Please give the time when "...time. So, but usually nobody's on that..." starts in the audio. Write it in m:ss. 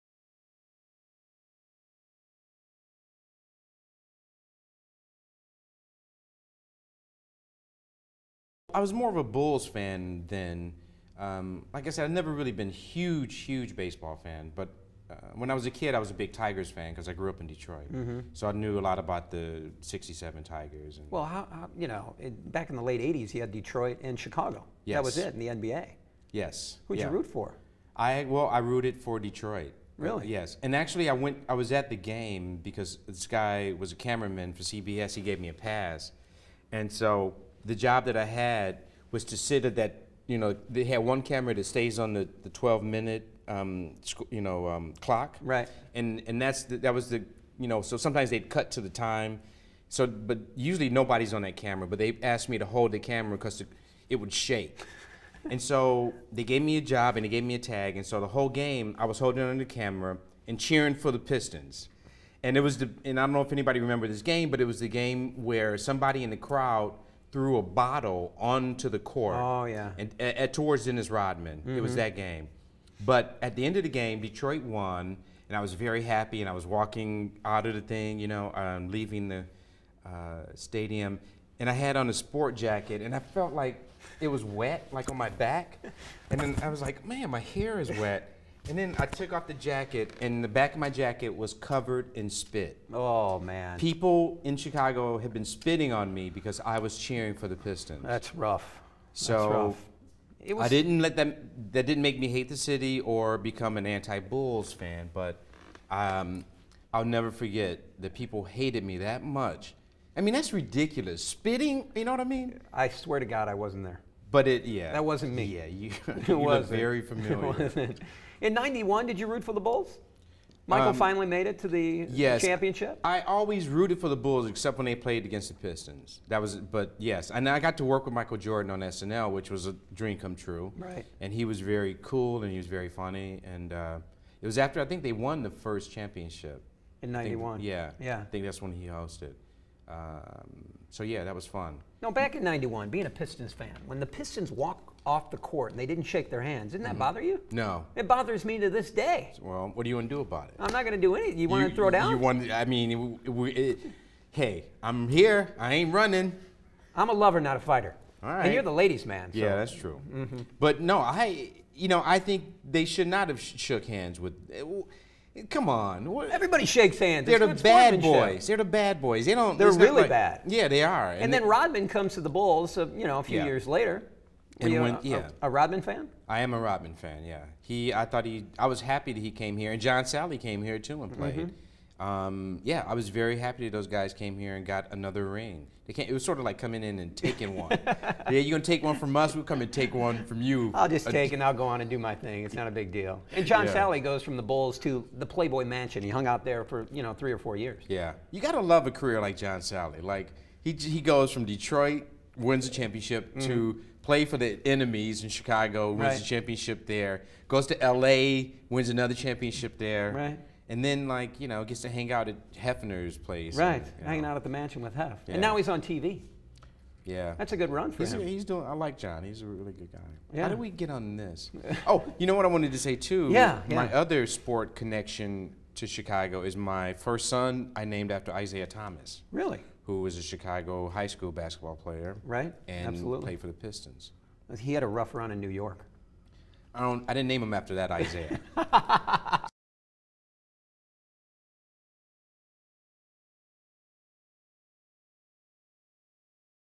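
0:48.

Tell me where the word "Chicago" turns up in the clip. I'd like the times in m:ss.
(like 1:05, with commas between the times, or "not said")
0:24, 1:34, 3:25, 3:45, 3:50.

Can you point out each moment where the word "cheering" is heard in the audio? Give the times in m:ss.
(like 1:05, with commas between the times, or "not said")
1:00, 1:36.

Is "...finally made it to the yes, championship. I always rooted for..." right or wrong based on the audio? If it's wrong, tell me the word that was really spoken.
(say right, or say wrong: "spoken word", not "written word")
right.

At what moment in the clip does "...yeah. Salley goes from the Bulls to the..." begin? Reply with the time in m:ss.
3:13.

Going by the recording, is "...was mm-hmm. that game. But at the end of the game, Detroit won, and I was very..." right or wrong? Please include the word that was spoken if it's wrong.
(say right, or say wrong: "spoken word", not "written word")
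right.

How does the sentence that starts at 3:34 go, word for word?
hanging out at the mansion with Hef, yeah.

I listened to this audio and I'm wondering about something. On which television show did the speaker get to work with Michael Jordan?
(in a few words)
SNL.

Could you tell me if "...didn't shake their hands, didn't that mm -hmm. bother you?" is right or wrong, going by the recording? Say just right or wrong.
right.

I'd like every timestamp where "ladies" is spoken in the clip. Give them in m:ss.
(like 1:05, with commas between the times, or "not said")
2:38.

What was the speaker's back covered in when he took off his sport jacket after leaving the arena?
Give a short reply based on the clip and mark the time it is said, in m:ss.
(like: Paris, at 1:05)
Spit, at 1:32.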